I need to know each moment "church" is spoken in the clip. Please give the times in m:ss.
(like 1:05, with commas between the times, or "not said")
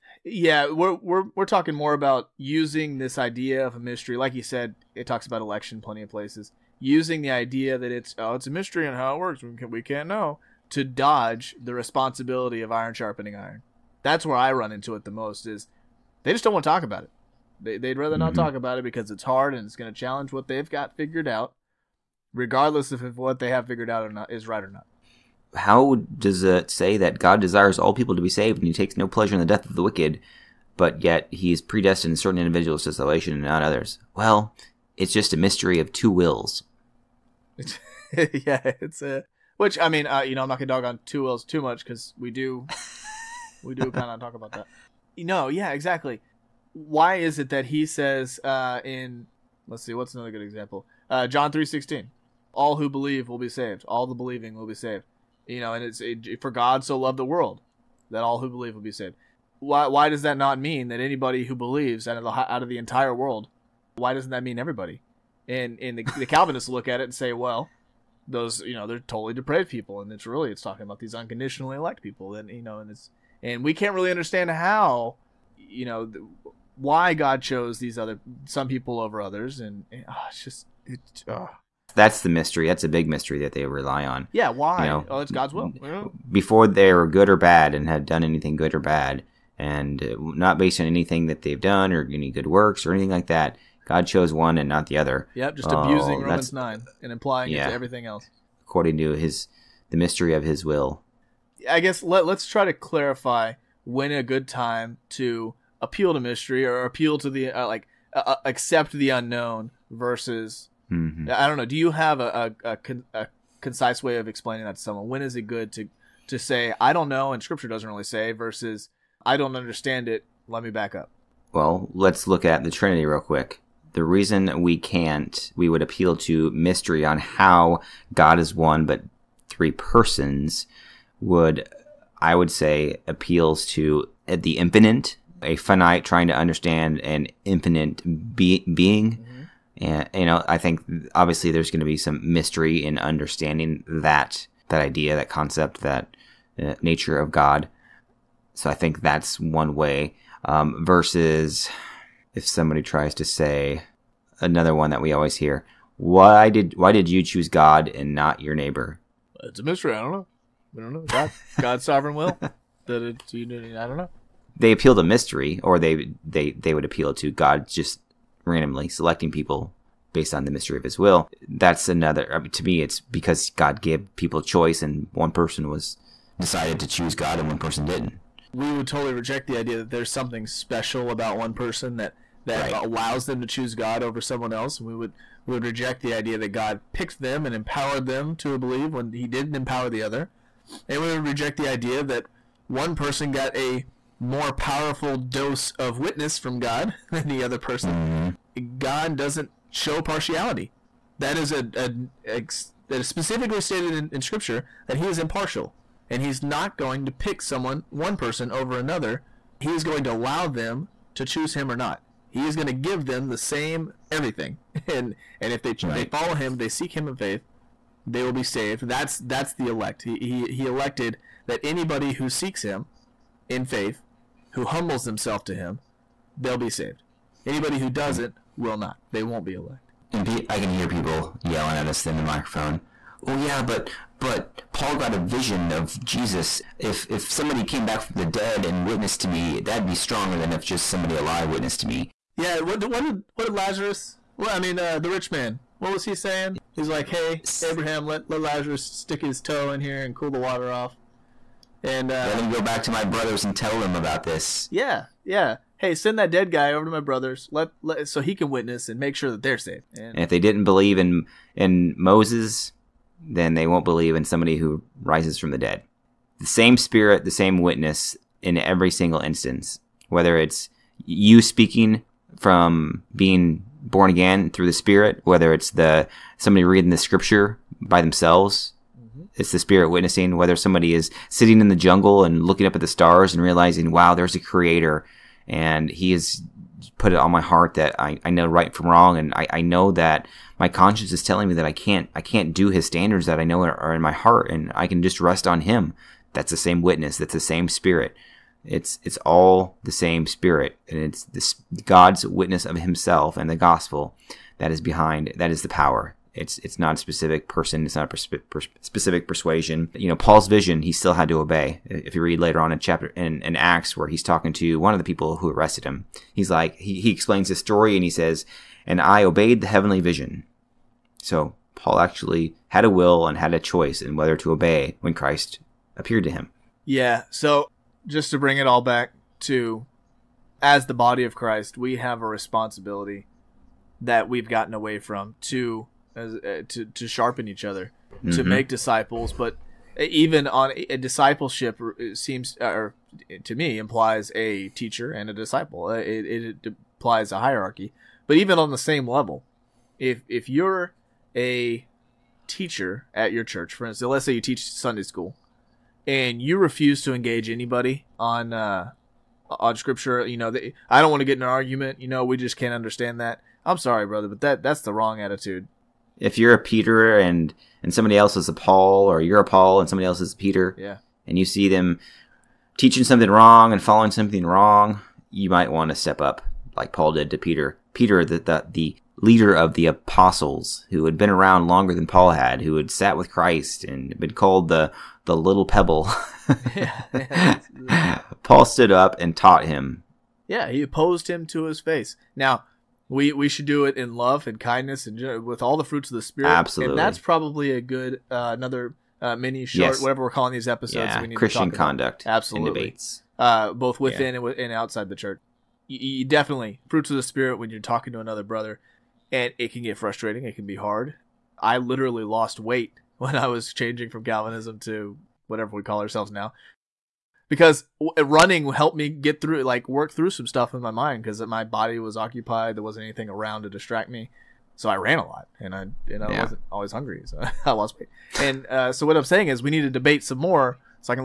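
5:53, 6:45.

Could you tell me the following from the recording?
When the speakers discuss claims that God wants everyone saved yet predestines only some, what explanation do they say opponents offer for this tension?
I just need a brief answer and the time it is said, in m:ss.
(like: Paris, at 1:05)
mystery of two wills, at 0:35.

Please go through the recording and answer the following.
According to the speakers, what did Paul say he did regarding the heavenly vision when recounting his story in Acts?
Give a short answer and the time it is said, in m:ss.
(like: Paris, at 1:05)
obeyed, at 5:19.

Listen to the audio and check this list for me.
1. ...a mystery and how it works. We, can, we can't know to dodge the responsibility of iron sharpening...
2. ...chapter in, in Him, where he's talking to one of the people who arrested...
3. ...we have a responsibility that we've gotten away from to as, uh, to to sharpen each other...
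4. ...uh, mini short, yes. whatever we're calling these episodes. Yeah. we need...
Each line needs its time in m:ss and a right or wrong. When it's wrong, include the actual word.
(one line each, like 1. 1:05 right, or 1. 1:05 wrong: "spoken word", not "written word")
1. 0:08 right
2. 5:12 wrong: "Acts", not "Him"
3. 5:31 right
4. 6:39 right.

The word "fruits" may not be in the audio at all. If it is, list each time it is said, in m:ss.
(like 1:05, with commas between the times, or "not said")
6:35, 6:46.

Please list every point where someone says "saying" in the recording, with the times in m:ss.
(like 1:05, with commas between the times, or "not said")
4:06, 7:09.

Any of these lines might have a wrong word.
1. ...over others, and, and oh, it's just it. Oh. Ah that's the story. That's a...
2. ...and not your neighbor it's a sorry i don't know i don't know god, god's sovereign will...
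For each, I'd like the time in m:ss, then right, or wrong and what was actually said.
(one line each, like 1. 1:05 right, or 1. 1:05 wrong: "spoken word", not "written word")
1. 1:18 wrong: "mystery", not "story"
2. 2:37 wrong: "mystery", not "sorry".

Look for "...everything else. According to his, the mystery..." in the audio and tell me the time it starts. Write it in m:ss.
1:37.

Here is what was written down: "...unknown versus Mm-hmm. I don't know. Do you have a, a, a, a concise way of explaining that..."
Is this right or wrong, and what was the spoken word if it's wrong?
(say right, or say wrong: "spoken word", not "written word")
right.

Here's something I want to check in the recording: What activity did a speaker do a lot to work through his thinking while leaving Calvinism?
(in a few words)
running.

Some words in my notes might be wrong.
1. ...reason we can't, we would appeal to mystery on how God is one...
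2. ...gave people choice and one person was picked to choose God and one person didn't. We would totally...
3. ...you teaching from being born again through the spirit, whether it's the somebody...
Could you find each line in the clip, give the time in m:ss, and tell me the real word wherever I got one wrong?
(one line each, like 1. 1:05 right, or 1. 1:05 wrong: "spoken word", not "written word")
1. 2:04 right
2. 2:53 wrong: "decided", not "picked"
3. 4:31 wrong: "speaking", not "teaching".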